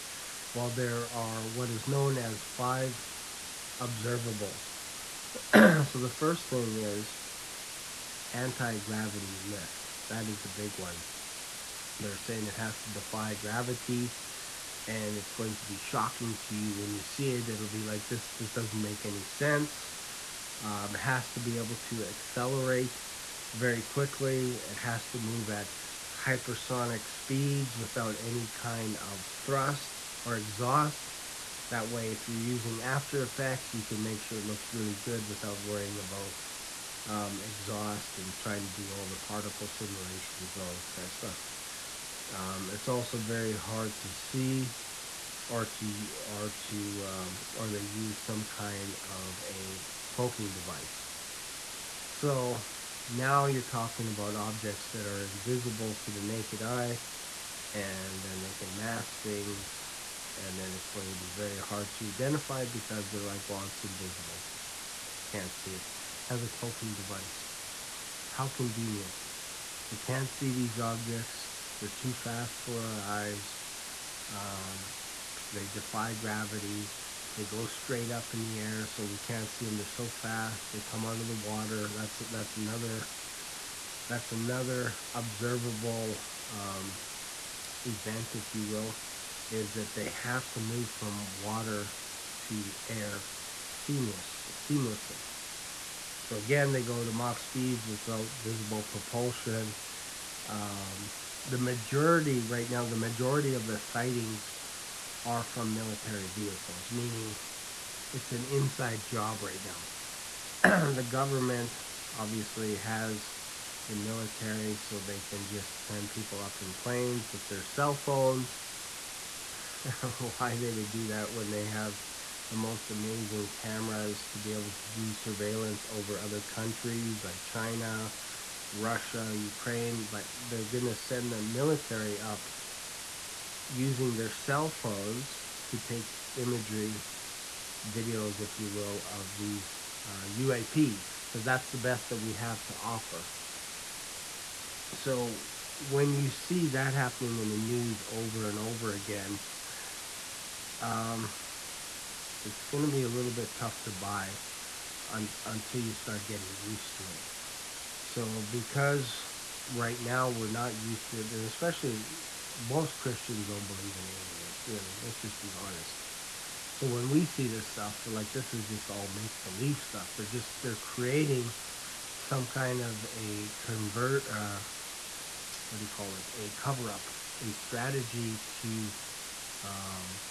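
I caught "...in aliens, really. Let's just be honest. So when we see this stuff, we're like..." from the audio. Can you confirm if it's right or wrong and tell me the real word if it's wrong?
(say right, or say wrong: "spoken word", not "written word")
right.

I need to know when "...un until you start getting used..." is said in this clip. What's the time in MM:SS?
02:35.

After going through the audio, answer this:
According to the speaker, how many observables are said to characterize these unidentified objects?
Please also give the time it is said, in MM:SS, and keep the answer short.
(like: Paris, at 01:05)
5, at 00:02.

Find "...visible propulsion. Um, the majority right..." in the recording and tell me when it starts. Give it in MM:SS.
01:38.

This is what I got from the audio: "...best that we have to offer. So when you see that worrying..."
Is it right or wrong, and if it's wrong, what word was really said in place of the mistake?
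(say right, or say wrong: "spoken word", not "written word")
wrong: "happening", not "worrying".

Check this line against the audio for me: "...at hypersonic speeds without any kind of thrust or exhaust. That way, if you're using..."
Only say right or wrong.
right.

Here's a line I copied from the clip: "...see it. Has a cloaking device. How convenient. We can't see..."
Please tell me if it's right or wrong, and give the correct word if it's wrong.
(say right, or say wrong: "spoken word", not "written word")
right.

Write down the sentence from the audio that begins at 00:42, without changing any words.
Um, it's also very hard to see or to, or to, um, or they use some kind of a cloaking device.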